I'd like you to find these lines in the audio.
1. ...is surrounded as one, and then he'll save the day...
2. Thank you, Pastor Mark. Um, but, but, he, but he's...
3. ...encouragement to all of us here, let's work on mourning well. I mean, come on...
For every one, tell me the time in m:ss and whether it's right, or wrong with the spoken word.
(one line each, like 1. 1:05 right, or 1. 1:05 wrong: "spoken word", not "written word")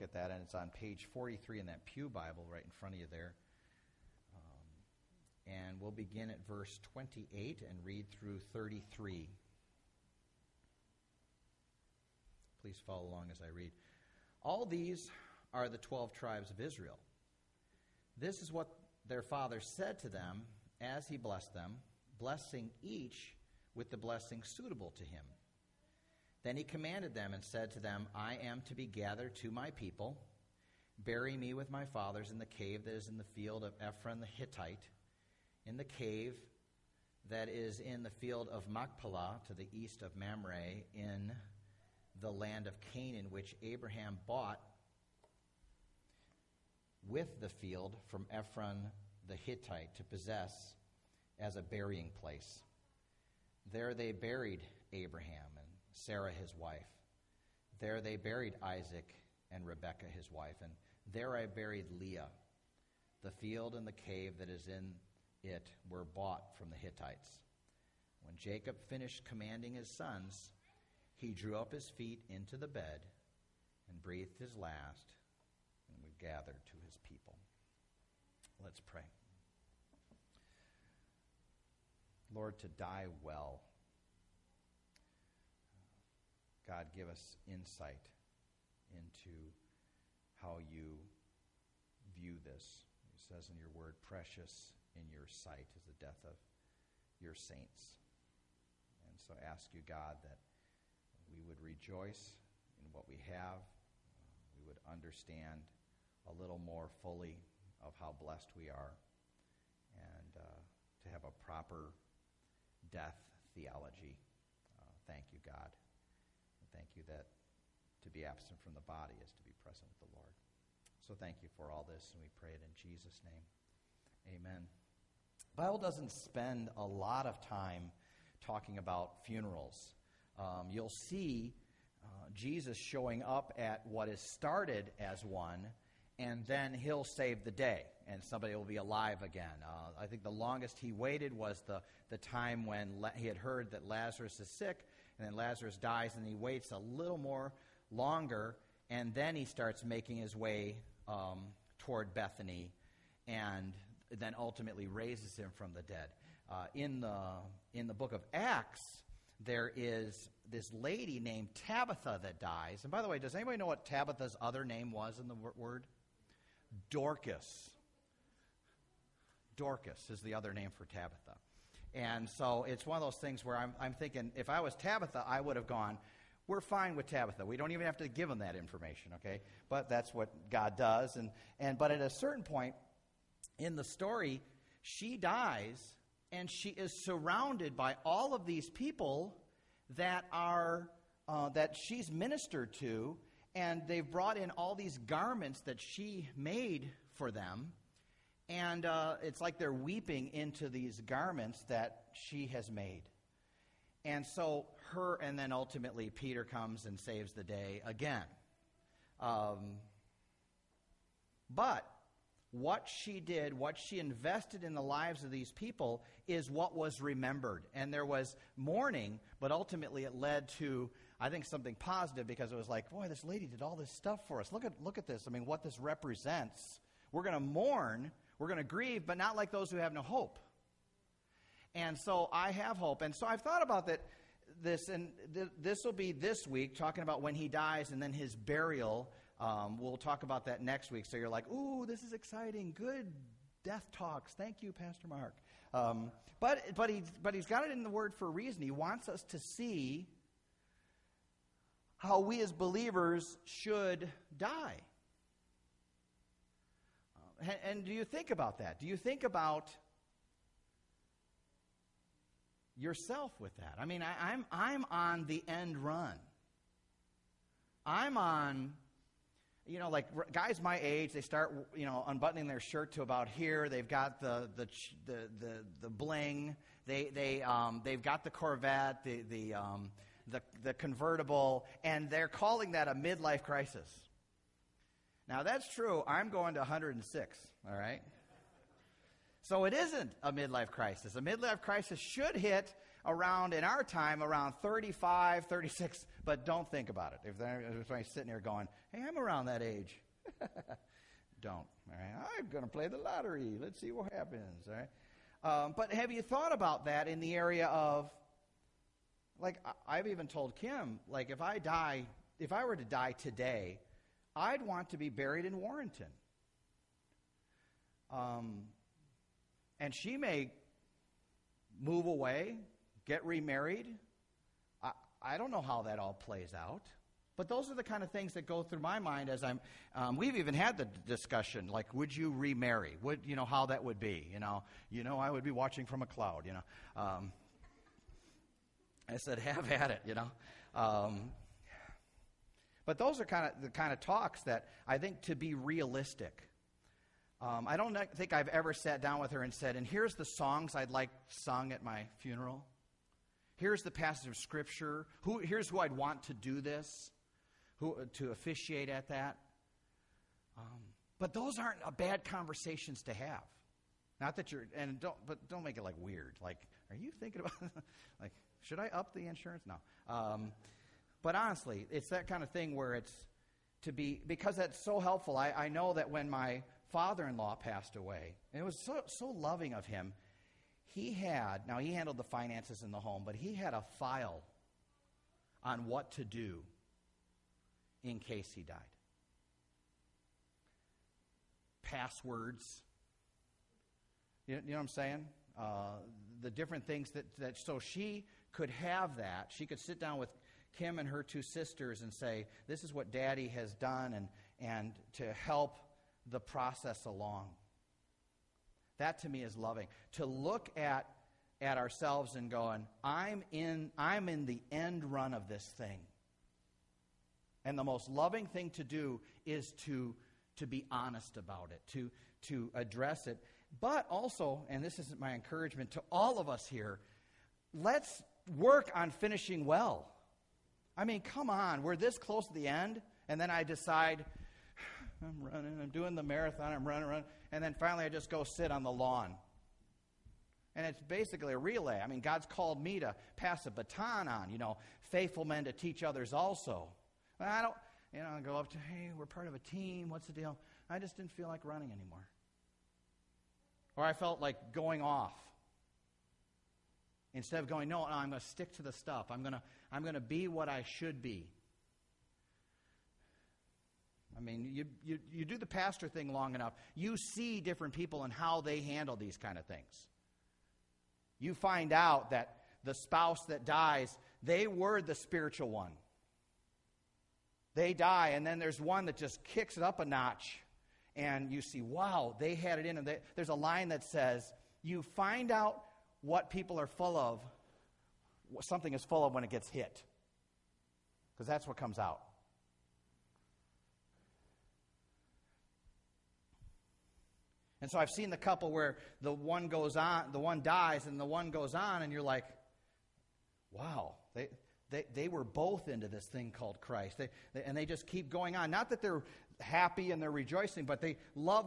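1. 2:14 wrong: "started", not "surrounded"
2. 4:04 right
3. 7:05 wrong: "finishing", not "mourning".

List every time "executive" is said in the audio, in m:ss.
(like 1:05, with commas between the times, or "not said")
not said.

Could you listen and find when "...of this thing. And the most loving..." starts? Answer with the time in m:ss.
6:55.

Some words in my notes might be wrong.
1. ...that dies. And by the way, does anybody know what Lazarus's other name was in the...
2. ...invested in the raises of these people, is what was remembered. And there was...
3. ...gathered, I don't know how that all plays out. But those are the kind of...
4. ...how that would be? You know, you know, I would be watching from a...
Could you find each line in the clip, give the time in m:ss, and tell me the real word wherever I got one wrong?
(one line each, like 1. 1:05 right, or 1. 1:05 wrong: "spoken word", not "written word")
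1. 2:42 wrong: "Tabitha", not "Lazarus"
2. 3:33 wrong: "lives", not "raises"
3. 5:23 wrong: "remarried", not "gathered"
4. 5:33 right.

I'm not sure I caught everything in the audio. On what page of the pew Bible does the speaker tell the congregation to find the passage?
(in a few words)
43.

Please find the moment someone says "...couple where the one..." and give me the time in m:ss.
8:18.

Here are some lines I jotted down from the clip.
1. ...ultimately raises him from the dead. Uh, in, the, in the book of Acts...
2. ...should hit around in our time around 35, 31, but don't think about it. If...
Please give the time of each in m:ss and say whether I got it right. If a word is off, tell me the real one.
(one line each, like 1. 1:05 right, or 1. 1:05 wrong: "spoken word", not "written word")
1. 2:34 right
2. 4:51 wrong: "36", not "31".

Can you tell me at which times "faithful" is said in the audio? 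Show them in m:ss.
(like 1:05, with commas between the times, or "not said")
7:25.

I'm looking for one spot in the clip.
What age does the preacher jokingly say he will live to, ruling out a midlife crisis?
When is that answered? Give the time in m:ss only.
4:46.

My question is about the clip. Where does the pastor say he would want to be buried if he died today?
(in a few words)
Warrenton.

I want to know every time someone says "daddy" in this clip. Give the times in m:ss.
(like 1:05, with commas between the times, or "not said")
6:43.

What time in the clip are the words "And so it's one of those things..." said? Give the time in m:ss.
2:51.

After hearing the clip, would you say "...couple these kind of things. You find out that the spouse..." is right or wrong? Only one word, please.
wrong.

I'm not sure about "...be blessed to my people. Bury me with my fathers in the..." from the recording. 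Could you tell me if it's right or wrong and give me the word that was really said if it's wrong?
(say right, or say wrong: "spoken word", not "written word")
wrong: "gathered", not "blessed".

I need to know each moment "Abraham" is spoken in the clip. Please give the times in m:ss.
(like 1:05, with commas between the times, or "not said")
0:43, 0:54.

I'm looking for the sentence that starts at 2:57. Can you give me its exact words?
We don't even have to give them that information, okay?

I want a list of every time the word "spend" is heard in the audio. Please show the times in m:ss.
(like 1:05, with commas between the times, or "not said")
2:06.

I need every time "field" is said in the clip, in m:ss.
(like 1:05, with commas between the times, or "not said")
0:33, 0:38, 0:47, 1:03.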